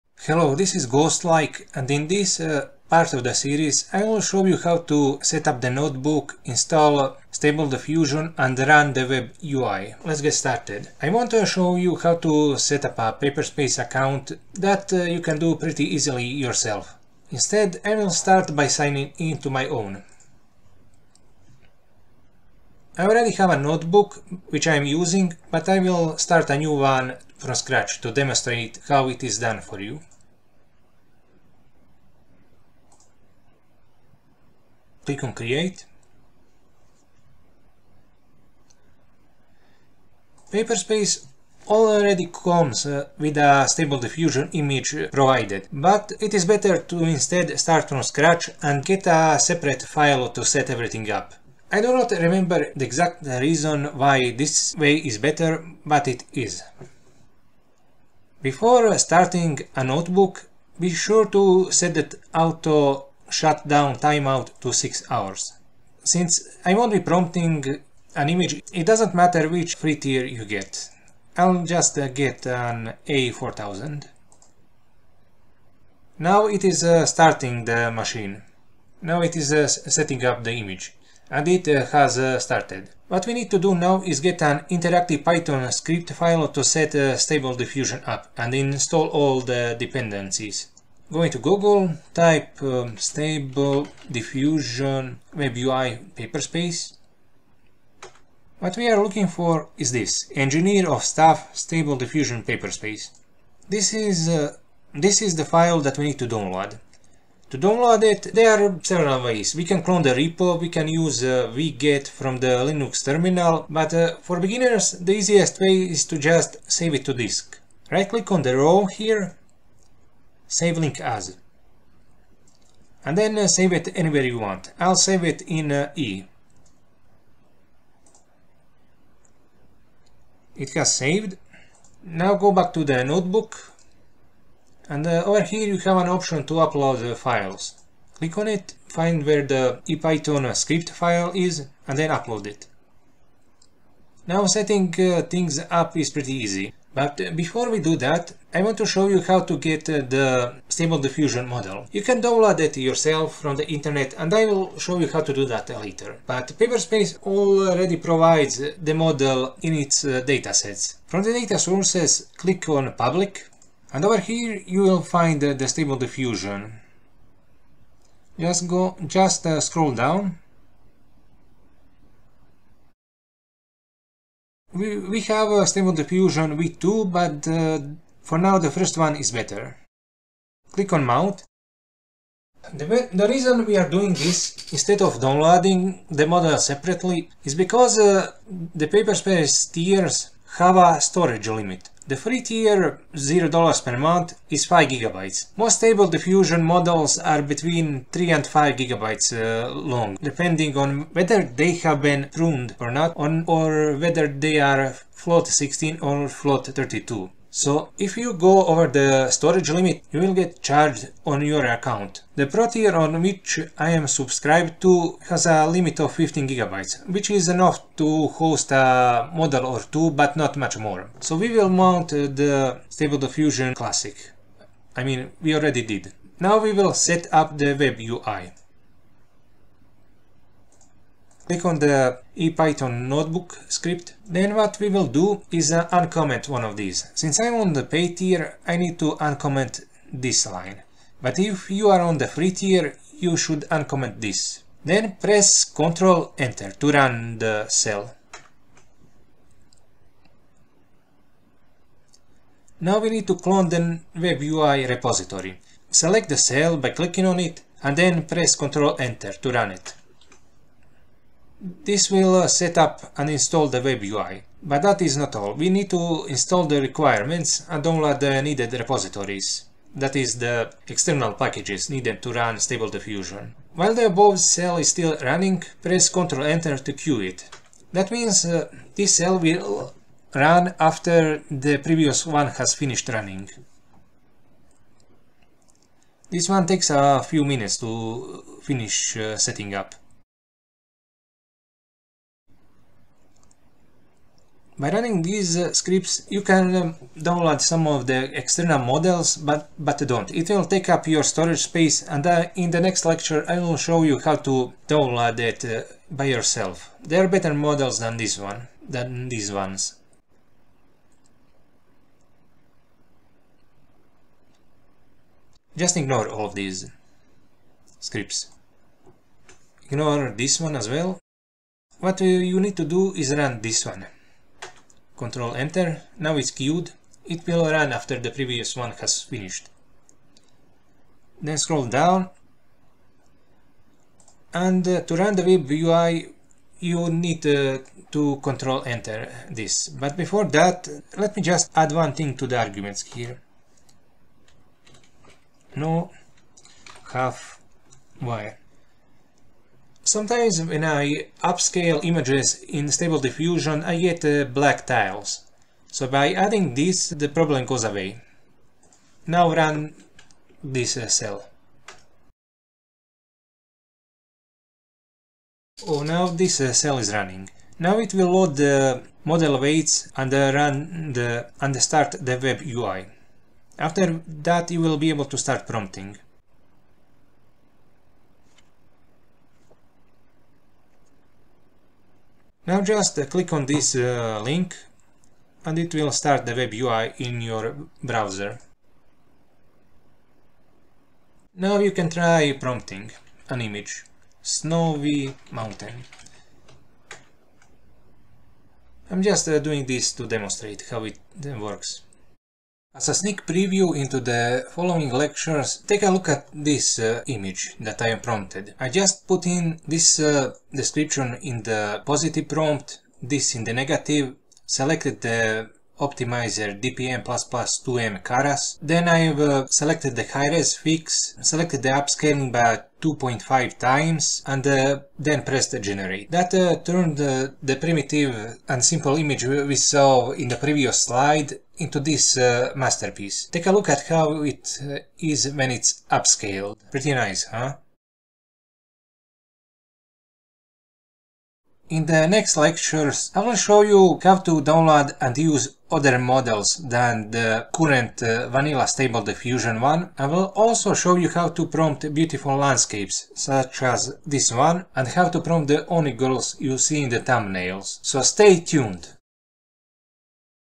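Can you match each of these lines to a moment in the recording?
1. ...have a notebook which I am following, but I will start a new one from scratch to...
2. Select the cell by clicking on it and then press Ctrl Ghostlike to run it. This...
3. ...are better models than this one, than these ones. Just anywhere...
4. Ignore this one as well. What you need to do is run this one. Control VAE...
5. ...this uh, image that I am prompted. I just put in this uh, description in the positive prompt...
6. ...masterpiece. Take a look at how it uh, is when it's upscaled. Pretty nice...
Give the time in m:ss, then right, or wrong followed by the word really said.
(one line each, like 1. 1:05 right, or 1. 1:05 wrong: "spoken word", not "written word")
1. 0:23 wrong: "using", not "following"
2. 4:15 wrong: "Enter", not "Ghostlike"
3. 5:07 wrong: "ignore", not "anywhere"
4. 5:19 wrong: "Enter", not "VAE"
5. 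6:46 right
6. 7:12 right.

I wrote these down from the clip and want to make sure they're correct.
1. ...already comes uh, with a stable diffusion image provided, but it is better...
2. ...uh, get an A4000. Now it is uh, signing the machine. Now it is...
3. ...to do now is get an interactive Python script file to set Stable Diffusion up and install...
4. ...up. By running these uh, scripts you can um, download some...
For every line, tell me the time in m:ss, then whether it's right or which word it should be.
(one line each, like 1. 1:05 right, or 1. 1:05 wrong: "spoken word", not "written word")
1. 0:41 right
2. 1:11 wrong: "starting", not "signing"
3. 1:23 right
4. 4:49 right.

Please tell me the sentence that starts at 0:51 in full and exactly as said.
I do not remember the exact reason why this way is better, but it is.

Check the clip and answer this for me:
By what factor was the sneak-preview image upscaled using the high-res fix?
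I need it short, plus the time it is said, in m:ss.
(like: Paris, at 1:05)
2.5 times, at 7:03.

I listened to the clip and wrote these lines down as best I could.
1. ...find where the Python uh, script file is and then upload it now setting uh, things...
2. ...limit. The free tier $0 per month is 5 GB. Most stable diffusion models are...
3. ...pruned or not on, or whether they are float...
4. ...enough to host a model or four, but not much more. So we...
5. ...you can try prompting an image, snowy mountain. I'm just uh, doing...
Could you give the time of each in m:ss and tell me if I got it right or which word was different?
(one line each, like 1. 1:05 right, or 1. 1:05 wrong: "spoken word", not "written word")
1. 2:18 right
2. 3:11 right
3. 3:22 right
4. 3:37 wrong: "two", not "four"
5. 6:31 right.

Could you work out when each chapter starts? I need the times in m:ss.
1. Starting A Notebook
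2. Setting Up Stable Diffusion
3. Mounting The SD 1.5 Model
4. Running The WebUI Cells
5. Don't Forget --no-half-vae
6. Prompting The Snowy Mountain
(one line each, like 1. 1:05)
1. 0:22
2. 1:32
3. 2:28
4. 3:51
5. 5:45
6. 6:31.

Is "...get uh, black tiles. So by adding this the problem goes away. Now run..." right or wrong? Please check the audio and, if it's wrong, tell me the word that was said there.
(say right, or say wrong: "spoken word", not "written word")
right.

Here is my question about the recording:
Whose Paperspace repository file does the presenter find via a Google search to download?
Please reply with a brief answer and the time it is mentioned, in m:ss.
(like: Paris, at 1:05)
Engineer of Stuff, at 1:40.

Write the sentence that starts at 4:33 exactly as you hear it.
While the above cell is still running, press Ctrl Enter to queue it.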